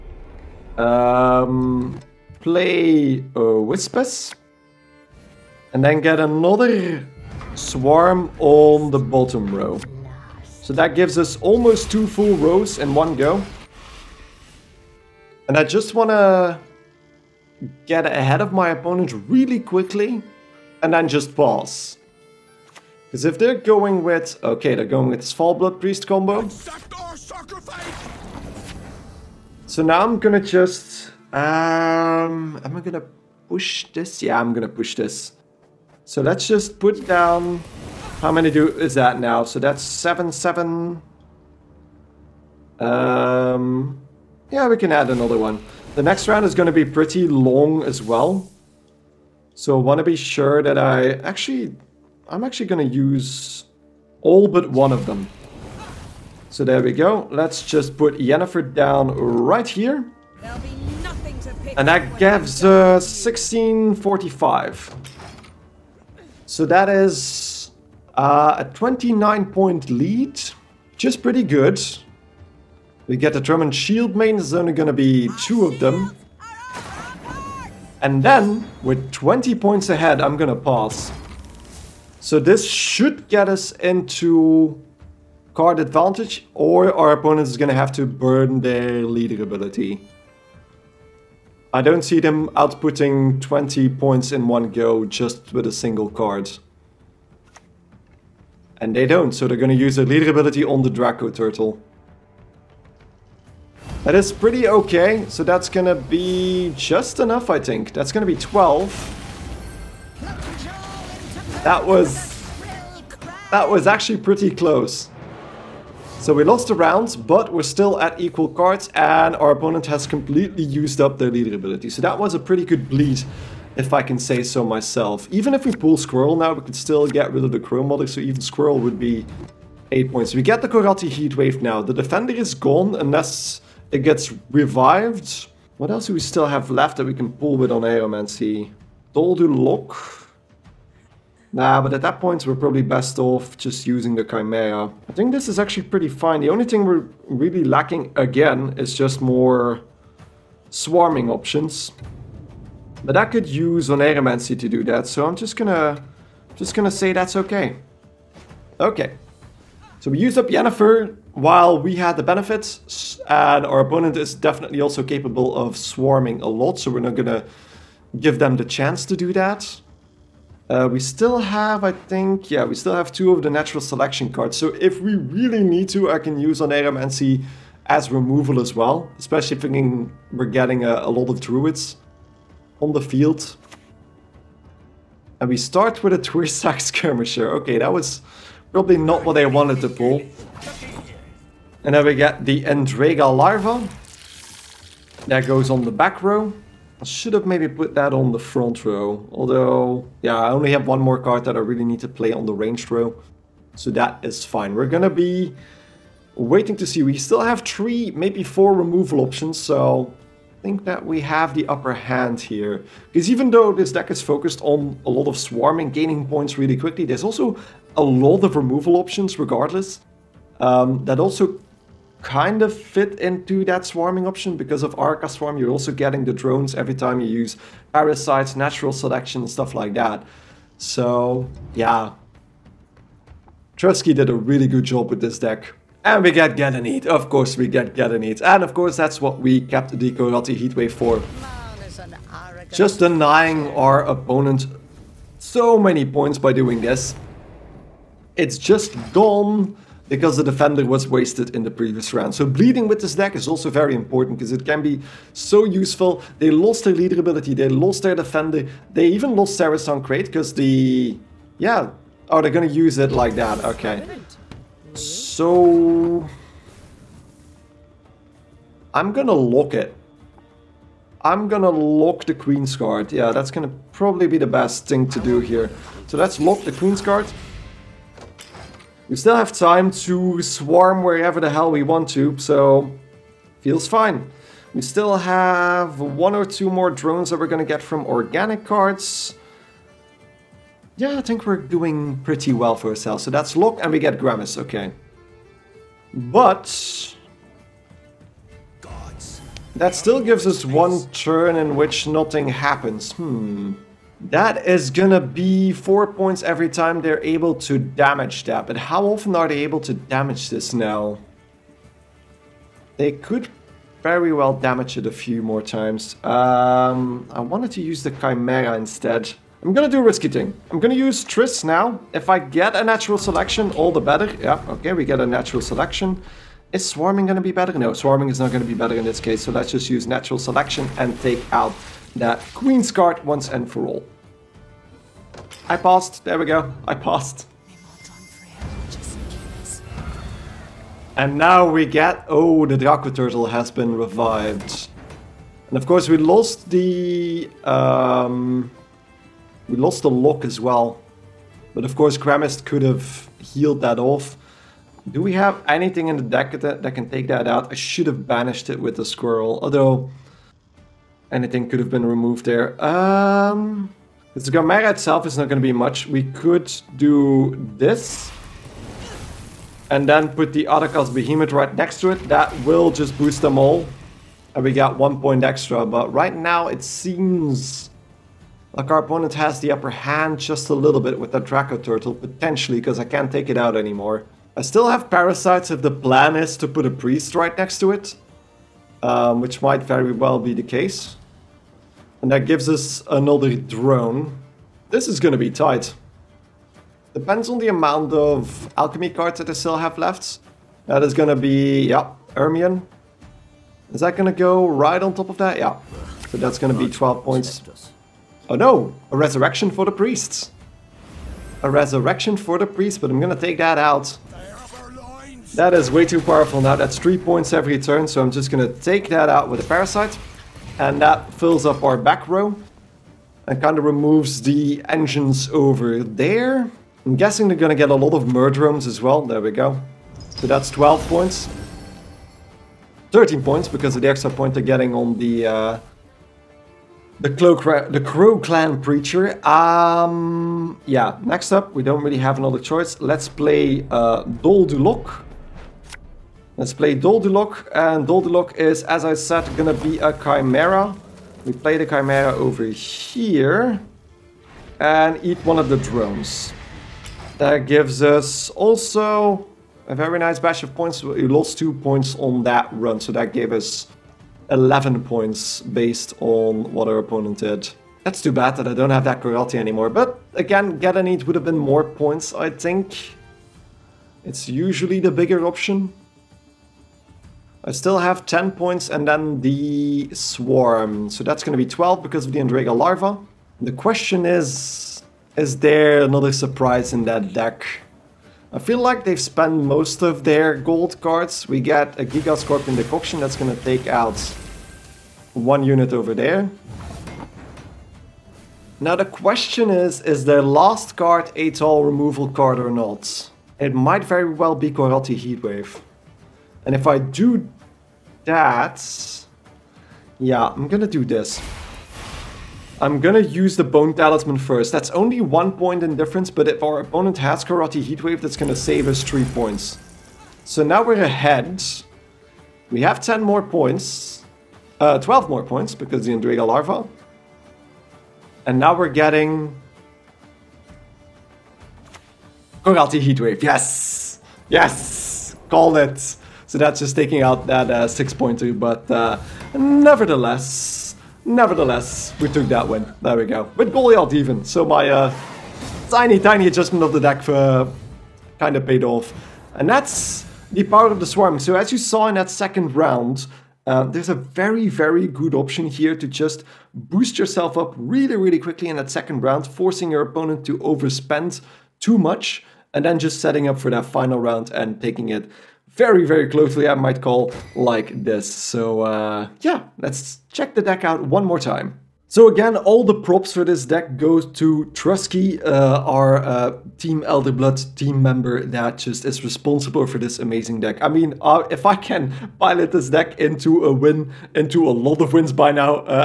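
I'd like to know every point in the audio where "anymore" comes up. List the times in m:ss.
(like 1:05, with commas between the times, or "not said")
6:23, 7:49.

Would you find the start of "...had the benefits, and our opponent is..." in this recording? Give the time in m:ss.
2:41.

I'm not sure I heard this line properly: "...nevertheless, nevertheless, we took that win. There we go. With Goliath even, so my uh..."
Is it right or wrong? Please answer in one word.
right.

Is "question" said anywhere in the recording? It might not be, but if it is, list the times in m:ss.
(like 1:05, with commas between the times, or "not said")
8:03, 8:19.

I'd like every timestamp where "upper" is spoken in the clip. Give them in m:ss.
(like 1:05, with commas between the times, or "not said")
3:31, 6:19.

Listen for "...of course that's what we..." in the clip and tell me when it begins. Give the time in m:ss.
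3:58.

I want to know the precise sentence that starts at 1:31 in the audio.
I don't see them outputting 20 points in one go just with a single card.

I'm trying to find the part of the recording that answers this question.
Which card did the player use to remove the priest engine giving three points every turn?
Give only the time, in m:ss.
6:59.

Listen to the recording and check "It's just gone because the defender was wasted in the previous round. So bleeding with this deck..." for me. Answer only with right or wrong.
right.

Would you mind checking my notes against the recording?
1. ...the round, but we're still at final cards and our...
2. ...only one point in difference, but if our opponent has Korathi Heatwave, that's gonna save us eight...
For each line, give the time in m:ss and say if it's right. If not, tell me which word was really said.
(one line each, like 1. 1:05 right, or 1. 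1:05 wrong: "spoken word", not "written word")
1. 1:56 wrong: "equal", not "final"
2. 8:34 wrong: "three", not "eight".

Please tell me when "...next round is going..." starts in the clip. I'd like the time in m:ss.
0:46.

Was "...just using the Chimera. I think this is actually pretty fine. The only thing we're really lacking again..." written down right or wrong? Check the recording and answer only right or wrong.
right.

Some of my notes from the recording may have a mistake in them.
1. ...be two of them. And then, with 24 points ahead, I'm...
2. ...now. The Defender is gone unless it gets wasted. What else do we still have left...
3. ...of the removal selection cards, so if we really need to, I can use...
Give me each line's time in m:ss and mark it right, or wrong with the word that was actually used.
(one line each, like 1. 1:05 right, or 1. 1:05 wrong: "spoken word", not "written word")
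1. 1:14 wrong: "20", not "24"
2. 2:11 wrong: "revived", not "wasted"
3. 2:53 wrong: "natural", not "removal".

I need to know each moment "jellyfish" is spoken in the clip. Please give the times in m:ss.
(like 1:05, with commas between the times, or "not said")
not said.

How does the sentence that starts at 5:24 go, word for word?
Yeah, okay, we get a natural selection.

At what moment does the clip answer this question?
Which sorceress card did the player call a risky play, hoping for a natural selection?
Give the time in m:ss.
5:21.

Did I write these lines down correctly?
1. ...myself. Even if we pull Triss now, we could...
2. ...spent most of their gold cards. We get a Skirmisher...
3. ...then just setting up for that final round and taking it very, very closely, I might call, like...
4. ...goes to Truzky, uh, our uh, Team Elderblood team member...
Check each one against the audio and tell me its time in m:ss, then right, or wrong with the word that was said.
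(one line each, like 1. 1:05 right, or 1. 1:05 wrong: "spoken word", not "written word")
1. 2:04 wrong: "Squirrel", not "Triss"
2. 8:09 wrong: "Giga", not "Skirmisher"
3. 9:22 right
4. 9:33 right.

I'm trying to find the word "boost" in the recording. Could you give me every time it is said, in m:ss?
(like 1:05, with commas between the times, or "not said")
6:13, 9:16.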